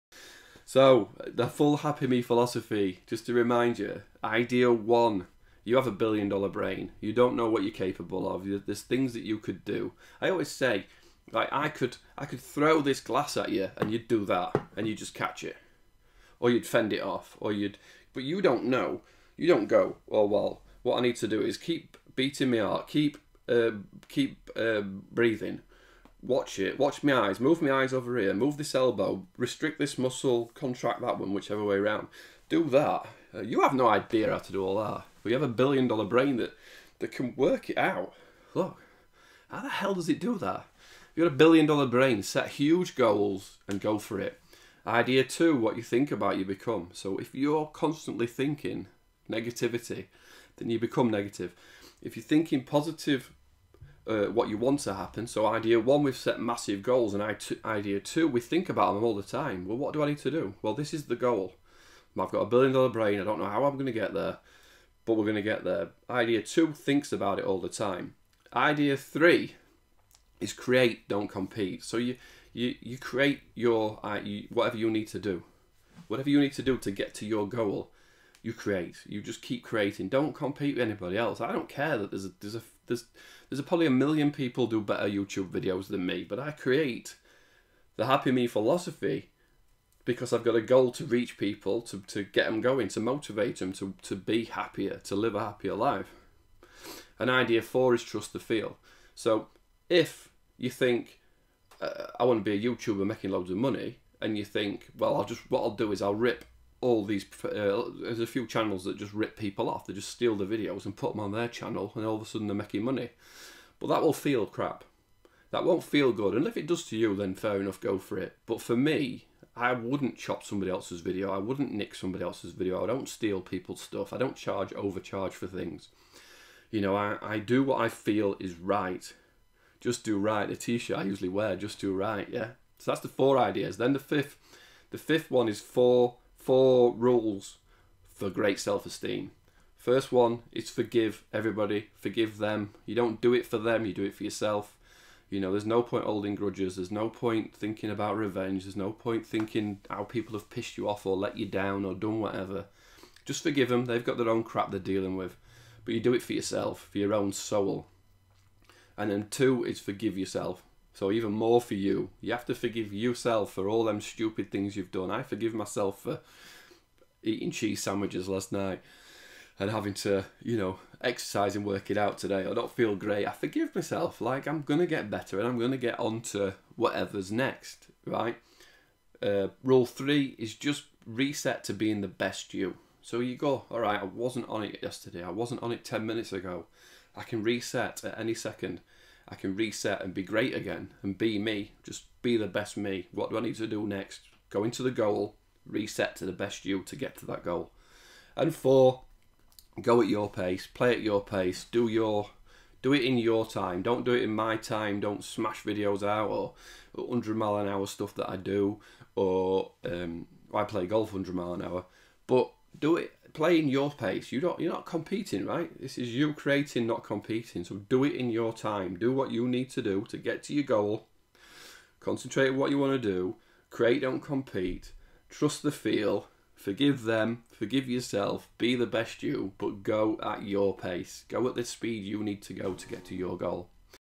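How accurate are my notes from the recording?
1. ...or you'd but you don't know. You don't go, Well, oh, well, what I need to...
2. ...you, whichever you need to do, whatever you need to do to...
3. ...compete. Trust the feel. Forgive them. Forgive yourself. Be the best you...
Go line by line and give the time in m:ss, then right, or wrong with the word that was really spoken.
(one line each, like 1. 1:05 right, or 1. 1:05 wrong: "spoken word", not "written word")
1. 0:17 right
2. 1:14 wrong: "whatever", not "whichever"
3. 3:44 right.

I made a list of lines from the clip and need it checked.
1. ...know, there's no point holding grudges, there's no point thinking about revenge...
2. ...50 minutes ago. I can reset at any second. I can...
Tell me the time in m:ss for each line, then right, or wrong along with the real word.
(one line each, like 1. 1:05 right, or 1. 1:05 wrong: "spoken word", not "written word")
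1. 2:25 right
2. 3:05 wrong: "10", not "50".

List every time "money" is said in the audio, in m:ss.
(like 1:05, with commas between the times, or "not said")
1:43, 1:52.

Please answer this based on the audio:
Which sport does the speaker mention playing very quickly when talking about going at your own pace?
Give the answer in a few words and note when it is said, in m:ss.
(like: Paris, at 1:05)
golf, at 3:30.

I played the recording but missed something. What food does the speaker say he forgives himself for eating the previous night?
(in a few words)
cheese sandwiches.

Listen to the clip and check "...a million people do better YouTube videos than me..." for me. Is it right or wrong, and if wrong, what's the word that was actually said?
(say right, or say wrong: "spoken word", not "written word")
right.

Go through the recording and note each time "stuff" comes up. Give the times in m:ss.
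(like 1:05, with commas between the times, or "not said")
2:03, 3:27.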